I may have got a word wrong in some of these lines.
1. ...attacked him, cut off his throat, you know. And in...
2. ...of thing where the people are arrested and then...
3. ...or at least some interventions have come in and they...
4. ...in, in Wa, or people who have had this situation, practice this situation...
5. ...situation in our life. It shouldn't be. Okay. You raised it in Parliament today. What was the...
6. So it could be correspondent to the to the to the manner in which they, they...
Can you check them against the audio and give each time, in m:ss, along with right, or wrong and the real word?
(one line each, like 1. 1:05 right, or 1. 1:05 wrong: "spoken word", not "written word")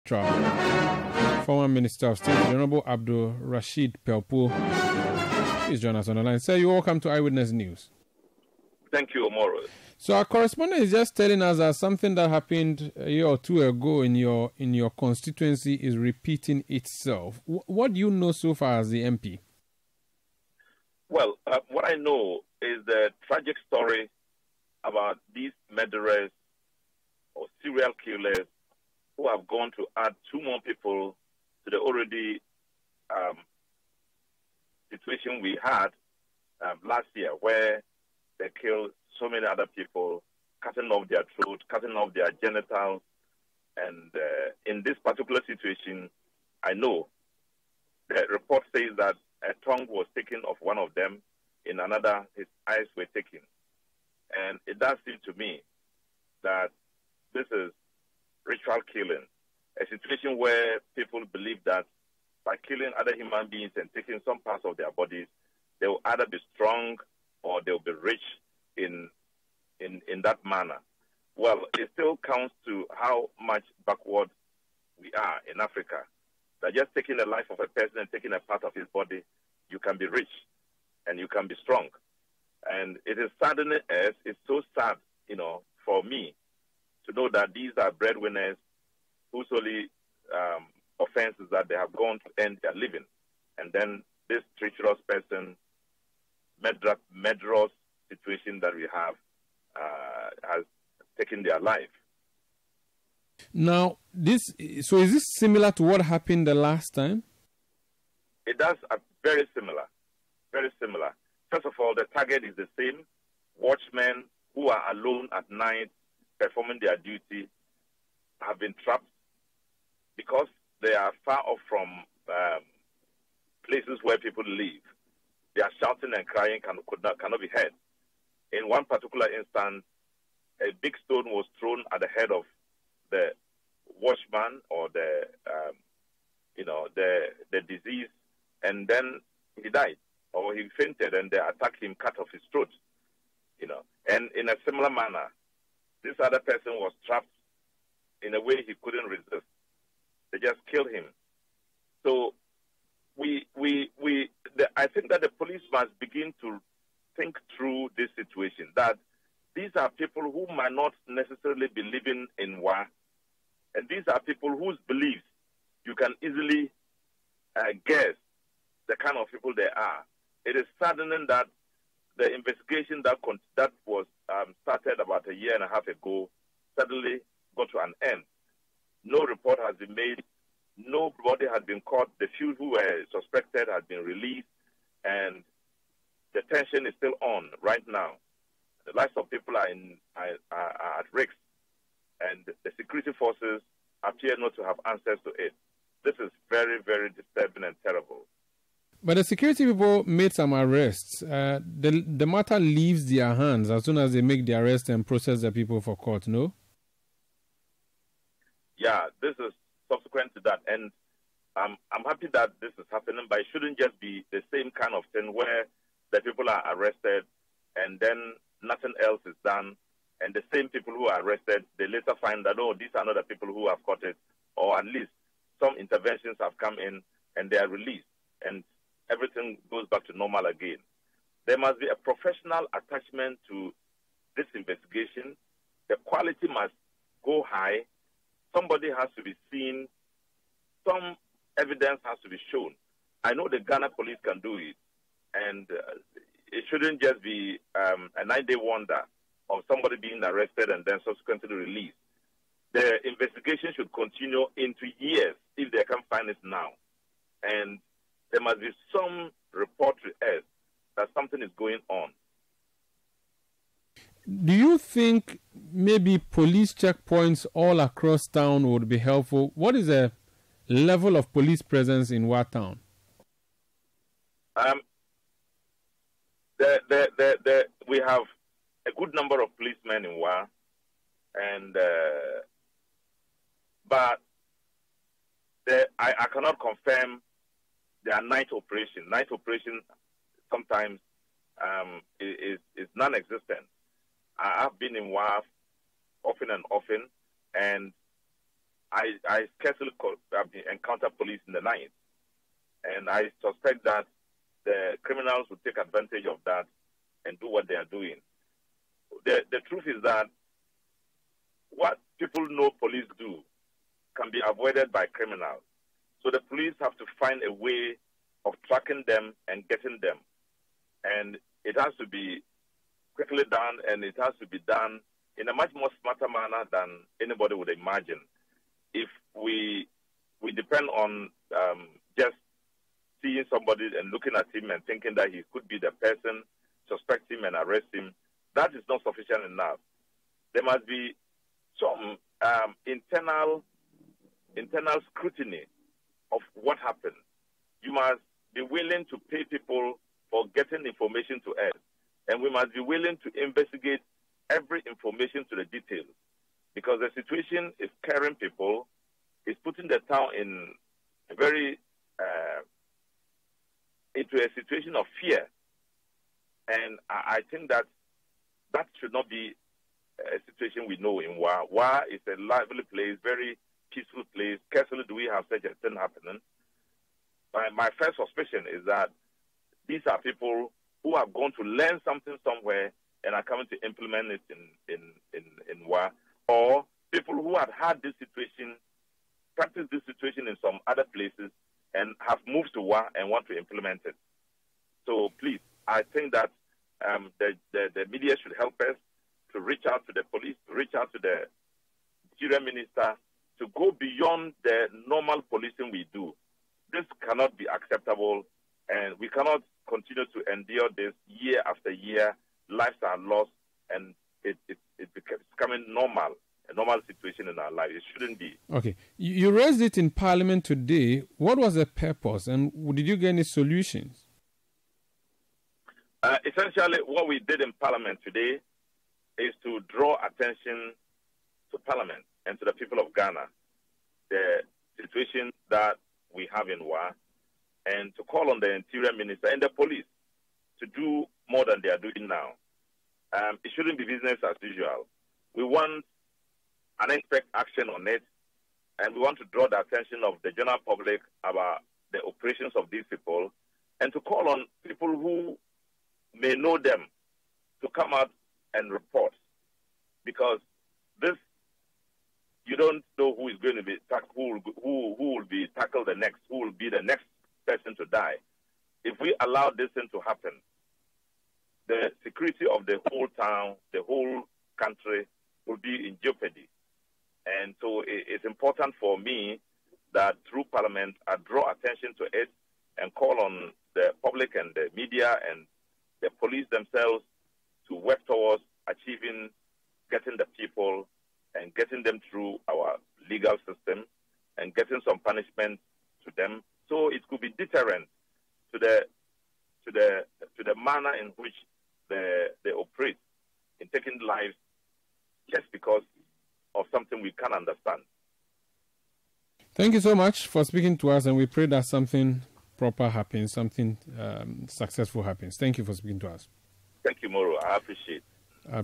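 1. 2:21 right
2. 3:34 right
3. 3:44 right
4. 6:25 right
5. 6:57 right
6. 8:16 wrong: "deterrent", not "correspondent".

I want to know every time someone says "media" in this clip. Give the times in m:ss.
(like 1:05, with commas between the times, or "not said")
6:38, 8:04.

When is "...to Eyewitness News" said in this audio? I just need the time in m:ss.
0:06.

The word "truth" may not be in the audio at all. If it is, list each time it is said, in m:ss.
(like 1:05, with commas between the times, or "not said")
5:09.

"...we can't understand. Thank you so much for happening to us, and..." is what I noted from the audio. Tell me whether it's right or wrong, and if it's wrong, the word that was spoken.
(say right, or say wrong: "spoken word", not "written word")
wrong: "speaking", not "happening".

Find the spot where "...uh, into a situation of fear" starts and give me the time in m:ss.
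6:02.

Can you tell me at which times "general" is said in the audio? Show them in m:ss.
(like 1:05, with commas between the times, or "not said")
7:30.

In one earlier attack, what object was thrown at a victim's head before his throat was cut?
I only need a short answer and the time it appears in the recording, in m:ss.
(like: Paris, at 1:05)
A big stone, at 2:10.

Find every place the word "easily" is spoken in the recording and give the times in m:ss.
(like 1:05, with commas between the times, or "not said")
2:46.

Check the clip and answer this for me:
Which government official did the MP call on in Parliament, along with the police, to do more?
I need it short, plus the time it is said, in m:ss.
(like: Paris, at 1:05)
Interior Minister, at 7:18.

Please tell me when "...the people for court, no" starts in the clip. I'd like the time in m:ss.
3:25.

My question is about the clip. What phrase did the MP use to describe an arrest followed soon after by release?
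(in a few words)
Nine-day wonder.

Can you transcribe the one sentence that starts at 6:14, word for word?
Carefully, do we have such a thing happening?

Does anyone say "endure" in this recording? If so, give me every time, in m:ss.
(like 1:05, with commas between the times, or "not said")
6:50.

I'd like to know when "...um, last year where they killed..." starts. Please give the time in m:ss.
0:36.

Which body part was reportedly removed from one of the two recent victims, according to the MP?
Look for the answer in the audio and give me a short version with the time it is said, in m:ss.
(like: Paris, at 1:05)
Tongue, at 0:49.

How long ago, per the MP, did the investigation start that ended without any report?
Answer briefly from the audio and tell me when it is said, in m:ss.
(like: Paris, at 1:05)
A year and a half, at 2:55.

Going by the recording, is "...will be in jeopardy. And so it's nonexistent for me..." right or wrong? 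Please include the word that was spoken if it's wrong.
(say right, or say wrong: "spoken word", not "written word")
wrong: "important", not "nonexistent".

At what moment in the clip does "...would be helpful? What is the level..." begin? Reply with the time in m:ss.
4:28.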